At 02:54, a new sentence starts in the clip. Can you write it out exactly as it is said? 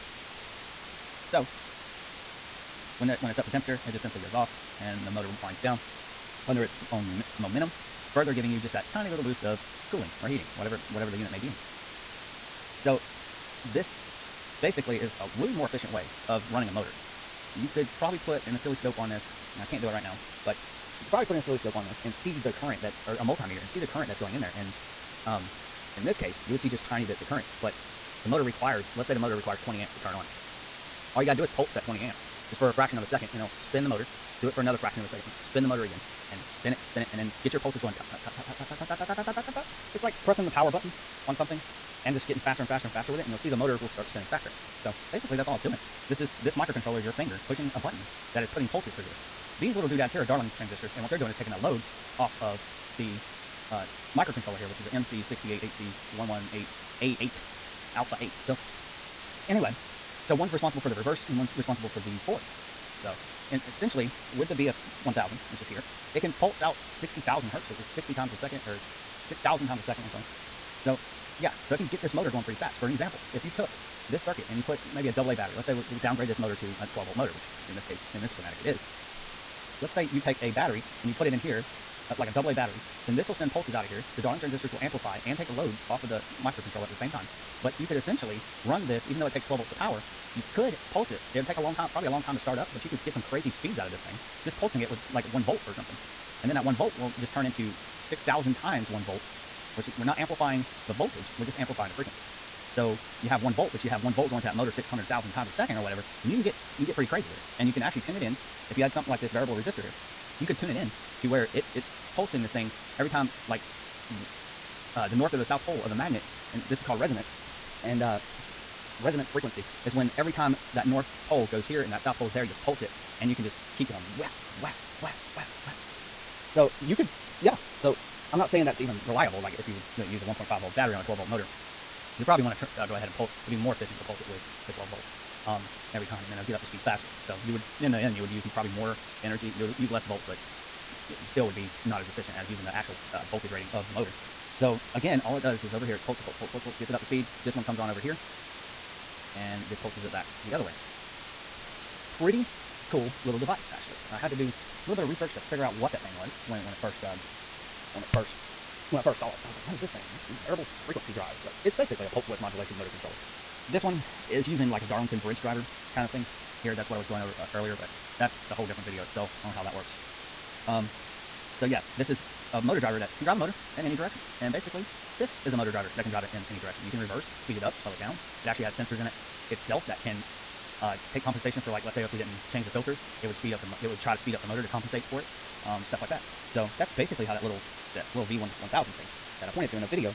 And basically, this is a motor driver that can drive it in any direction.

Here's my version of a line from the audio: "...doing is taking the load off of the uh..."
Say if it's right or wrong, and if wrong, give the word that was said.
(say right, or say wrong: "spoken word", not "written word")
right.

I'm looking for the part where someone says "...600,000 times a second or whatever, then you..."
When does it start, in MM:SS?
01:44.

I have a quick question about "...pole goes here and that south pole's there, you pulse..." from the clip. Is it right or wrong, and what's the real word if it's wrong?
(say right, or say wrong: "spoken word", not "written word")
right.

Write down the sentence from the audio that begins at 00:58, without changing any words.
So, anyway, so one's responsible for the reverse and one's responsible for the forward.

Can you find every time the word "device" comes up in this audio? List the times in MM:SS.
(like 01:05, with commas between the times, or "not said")
02:33.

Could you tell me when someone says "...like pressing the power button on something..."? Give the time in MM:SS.
00:40.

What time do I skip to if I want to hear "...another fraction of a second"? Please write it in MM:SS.
00:34.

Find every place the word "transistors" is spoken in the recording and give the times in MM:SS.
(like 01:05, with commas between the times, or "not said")
00:50, 01:24.